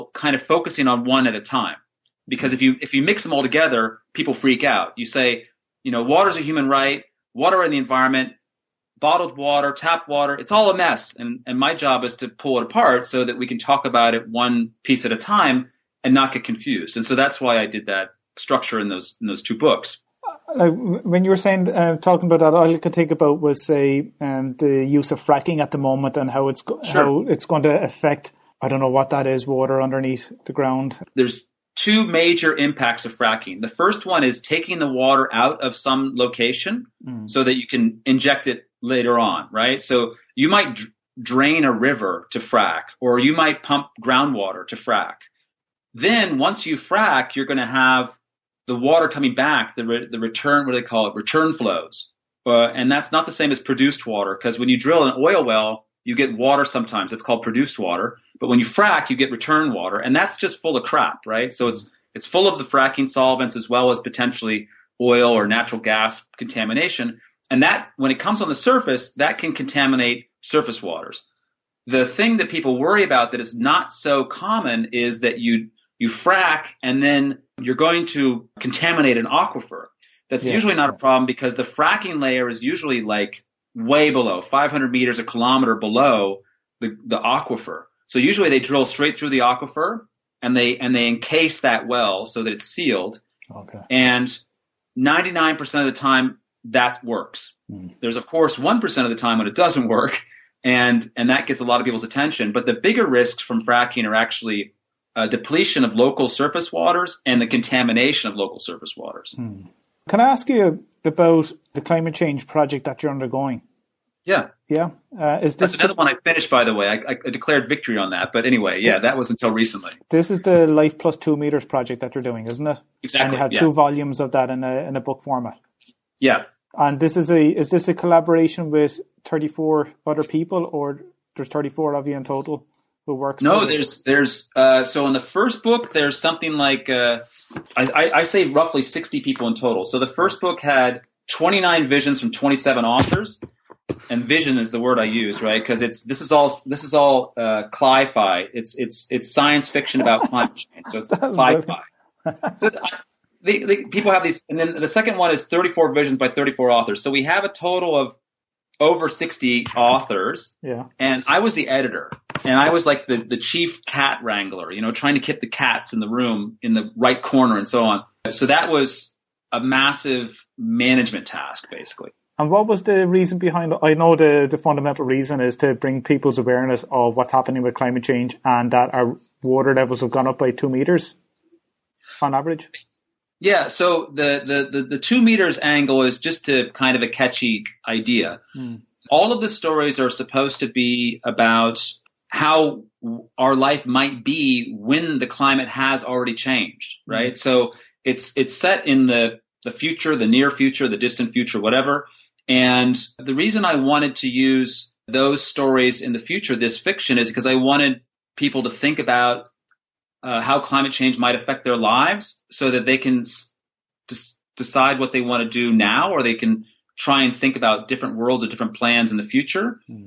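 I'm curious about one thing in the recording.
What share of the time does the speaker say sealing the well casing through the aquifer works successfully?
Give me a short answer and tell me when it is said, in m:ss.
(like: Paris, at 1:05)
99%, at 1:34.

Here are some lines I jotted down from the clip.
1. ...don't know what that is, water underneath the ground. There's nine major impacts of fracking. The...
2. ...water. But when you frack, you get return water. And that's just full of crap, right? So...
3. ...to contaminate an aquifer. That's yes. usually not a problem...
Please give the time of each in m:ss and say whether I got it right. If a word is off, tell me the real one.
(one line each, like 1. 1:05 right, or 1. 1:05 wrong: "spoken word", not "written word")
1. 0:28 wrong: "two", not "nine"
2. 0:57 right
3. 1:18 right.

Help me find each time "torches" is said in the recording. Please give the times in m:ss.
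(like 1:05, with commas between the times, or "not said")
not said.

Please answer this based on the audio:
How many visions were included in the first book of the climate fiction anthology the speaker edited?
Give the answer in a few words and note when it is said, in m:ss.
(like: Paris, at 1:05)
29, at 2:21.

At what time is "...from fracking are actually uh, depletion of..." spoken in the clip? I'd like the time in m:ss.
1:43.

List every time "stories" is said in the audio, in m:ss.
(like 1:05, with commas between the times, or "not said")
3:09, 3:25.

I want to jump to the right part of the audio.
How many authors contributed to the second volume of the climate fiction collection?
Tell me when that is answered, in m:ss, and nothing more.
2:36.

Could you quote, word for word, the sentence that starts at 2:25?
Because it's this is all this is all uh, cli-fi.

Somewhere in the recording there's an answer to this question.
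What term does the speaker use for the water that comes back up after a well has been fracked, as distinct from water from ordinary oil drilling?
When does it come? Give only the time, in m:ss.
0:51.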